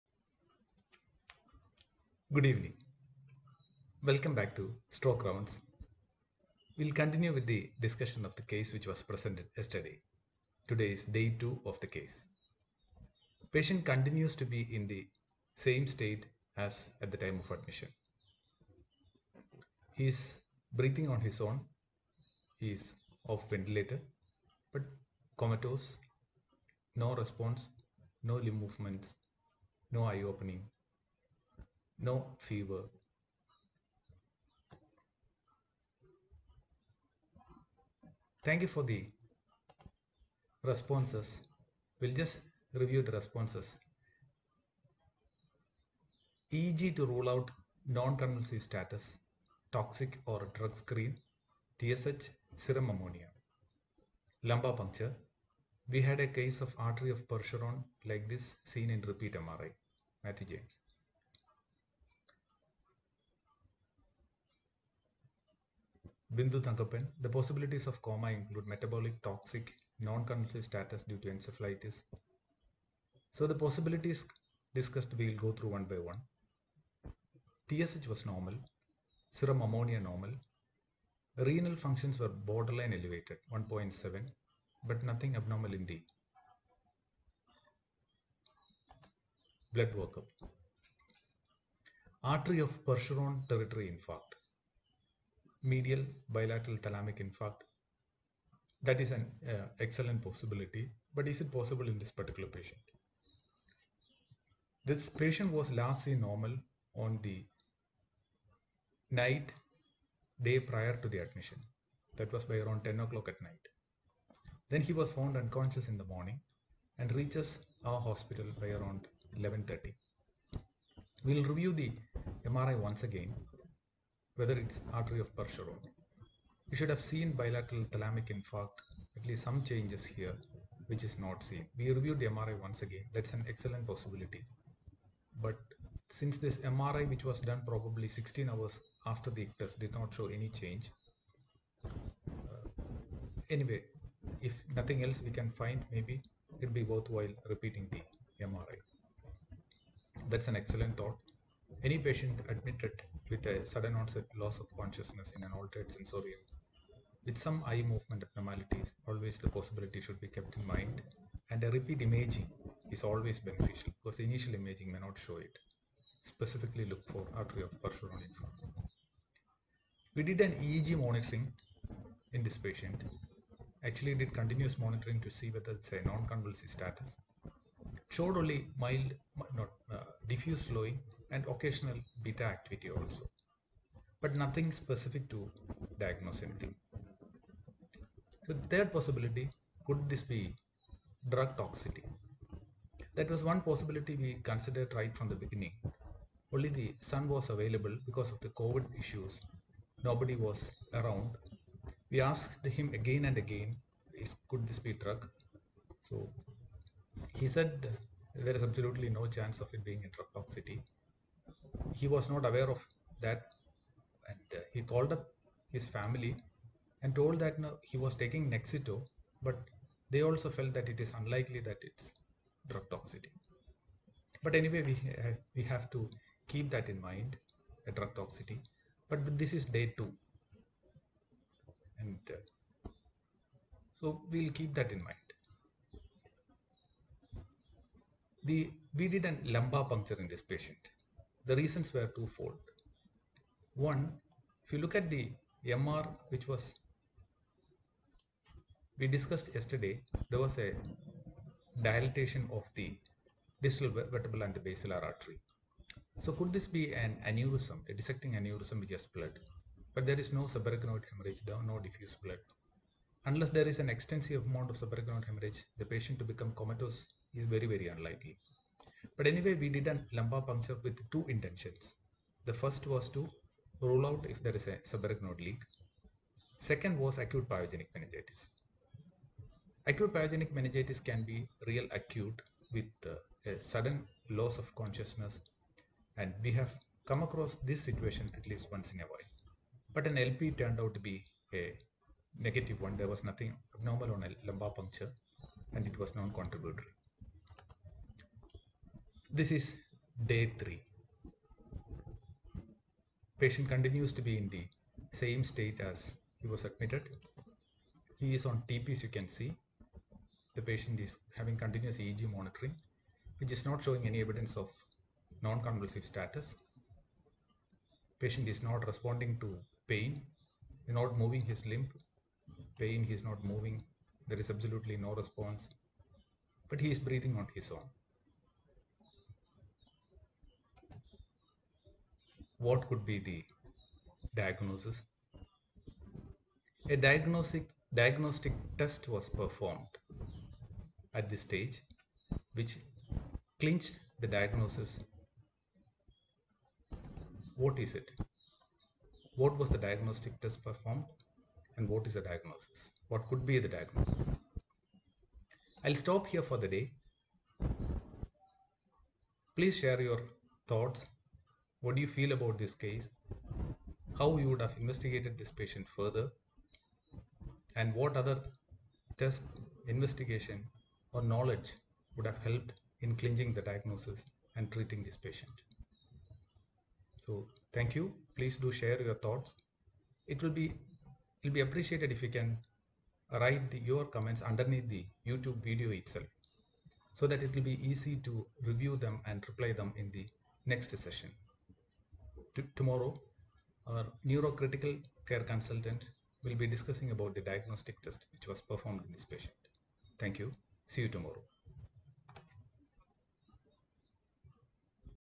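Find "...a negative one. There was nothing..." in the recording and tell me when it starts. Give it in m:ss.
4:51.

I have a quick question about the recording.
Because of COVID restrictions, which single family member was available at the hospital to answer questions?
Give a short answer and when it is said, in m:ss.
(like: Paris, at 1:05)
The son, at 3:16.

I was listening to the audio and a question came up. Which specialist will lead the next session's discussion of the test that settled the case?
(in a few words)
Neurocritical care consultant.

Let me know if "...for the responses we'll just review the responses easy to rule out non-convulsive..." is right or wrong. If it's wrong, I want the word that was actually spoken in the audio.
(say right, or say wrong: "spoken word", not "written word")
right.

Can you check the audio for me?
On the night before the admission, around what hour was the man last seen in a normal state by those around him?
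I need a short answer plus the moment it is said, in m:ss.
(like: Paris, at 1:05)
10 o'clock, at 1:52.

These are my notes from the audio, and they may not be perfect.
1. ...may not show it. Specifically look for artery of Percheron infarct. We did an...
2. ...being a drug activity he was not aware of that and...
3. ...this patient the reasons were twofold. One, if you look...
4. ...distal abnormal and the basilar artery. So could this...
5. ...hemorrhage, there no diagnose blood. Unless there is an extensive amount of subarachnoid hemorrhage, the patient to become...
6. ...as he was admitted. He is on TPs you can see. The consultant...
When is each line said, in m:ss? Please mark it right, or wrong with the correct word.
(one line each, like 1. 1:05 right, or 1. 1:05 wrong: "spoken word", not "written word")
1. 2:44 right
2. 3:29 wrong: "toxicity", not "activity"
3. 4:00 right
4. 4:13 wrong: "vertebral", not "abnormal"
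5. 4:21 wrong: "diffuse", not "diagnose"
6. 5:05 wrong: "patient", not "consultant".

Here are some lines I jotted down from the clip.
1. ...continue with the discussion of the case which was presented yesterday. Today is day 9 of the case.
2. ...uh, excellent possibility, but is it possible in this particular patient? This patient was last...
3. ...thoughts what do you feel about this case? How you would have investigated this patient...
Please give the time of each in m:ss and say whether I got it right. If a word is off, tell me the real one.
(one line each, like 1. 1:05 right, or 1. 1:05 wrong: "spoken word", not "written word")
1. 0:06 wrong: "2", not "9"
2. 1:39 right
3. 6:00 right.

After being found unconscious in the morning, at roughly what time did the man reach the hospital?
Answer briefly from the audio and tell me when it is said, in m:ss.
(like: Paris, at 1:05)
11:30, at 1:59.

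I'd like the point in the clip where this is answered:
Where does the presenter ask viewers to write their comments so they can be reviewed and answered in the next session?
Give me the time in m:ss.
6:25.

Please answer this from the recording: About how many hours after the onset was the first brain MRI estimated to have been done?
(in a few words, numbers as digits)
16.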